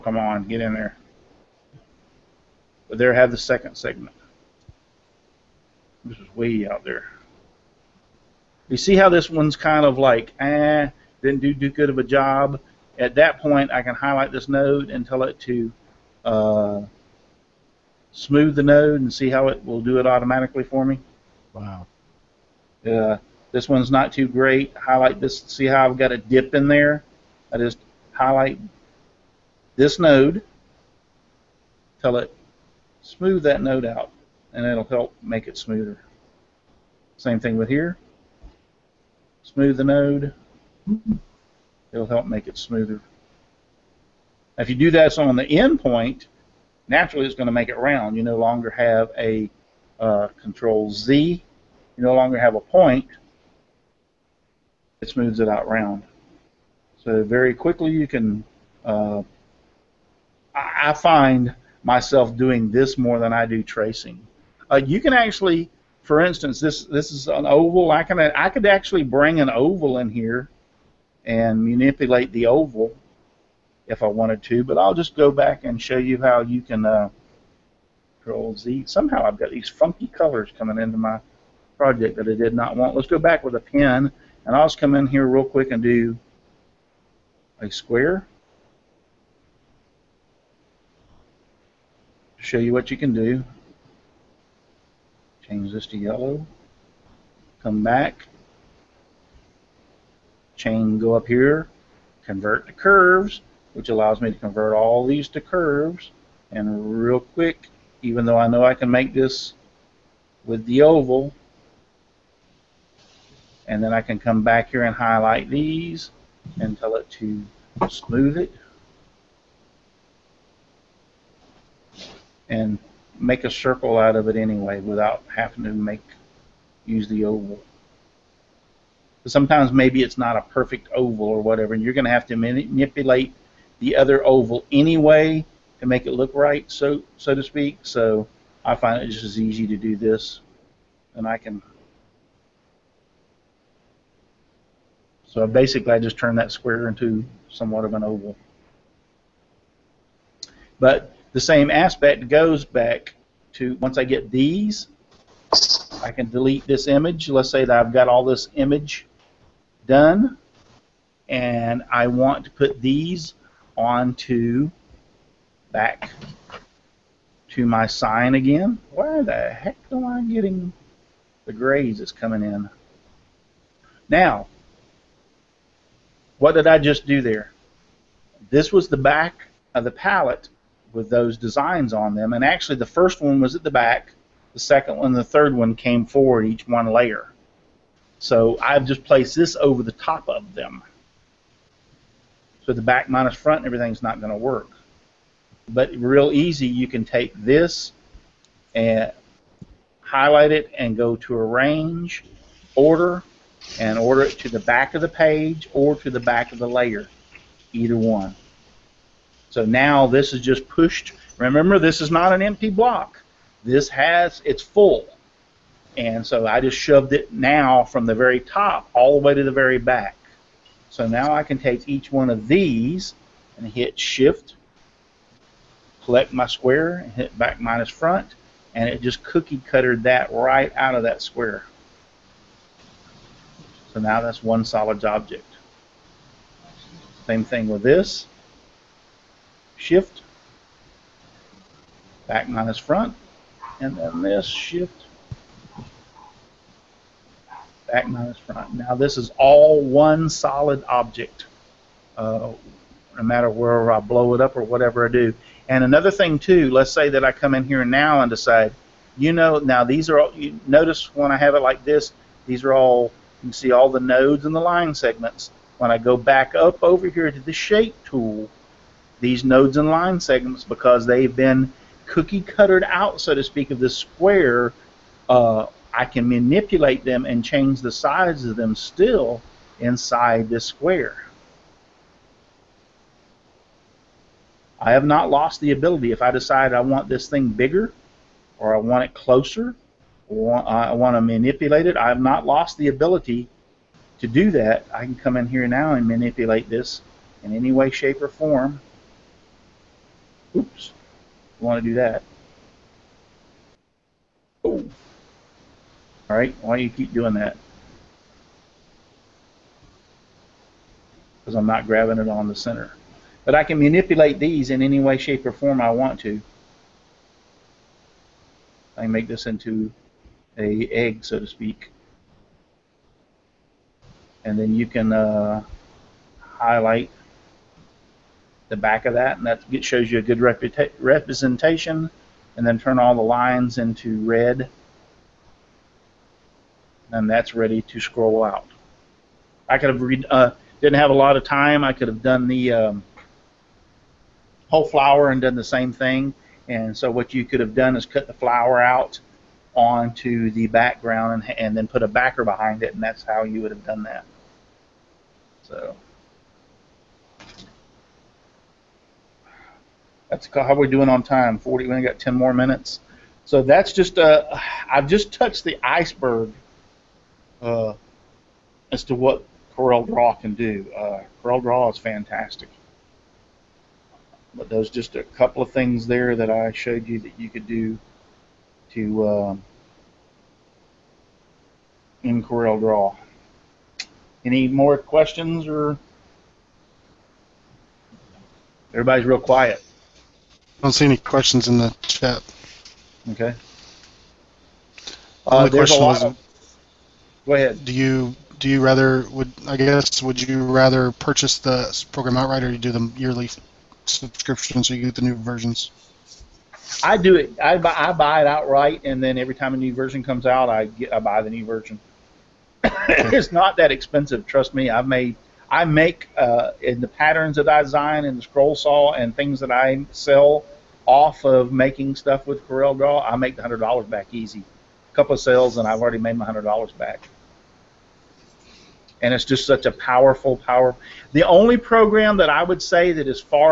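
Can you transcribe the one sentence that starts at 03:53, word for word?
So now that's one solid object.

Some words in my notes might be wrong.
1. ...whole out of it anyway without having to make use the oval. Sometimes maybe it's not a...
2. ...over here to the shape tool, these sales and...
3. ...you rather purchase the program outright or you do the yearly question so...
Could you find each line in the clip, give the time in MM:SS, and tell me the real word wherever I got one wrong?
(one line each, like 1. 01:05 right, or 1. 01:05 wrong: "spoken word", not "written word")
1. 02:03 wrong: "circle", not "whole"
2. 04:26 wrong: "nodes", not "sales"
3. 06:40 wrong: "subscription", not "question".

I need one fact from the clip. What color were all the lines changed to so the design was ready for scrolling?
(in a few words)
red.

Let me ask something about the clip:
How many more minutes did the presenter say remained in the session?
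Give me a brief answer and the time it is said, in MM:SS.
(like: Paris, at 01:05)
10, at 06:02.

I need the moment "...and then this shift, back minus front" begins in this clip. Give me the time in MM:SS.
04:03.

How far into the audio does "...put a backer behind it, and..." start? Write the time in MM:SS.
05:51.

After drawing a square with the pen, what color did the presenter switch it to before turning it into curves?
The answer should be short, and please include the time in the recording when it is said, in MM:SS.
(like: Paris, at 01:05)
yellow, at 01:35.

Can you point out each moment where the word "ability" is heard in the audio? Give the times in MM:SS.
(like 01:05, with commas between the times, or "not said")
04:45, 04:52.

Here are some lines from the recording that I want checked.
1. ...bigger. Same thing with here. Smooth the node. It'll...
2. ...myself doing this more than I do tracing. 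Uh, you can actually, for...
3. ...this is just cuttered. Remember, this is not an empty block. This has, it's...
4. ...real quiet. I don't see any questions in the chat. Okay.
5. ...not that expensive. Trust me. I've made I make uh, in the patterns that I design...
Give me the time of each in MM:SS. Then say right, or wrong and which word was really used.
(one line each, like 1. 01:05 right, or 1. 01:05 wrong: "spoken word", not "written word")
1. 00:35 wrong: "smoother", not "bigger"
2. 01:01 right
3. 03:30 wrong: "pushed", not "cuttered"
4. 06:29 right
5. 06:53 right.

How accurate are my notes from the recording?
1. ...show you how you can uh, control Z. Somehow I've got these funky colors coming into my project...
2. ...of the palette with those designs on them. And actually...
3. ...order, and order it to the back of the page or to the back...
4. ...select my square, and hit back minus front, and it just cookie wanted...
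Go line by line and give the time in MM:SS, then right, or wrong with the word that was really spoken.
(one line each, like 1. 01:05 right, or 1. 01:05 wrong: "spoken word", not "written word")
1. 01:15 right
2. 02:59 right
3. 03:22 right
4. 03:46 wrong: "cuttered", not "wanted".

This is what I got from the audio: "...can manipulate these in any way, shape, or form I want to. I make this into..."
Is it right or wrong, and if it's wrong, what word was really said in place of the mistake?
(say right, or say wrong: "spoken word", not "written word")
right.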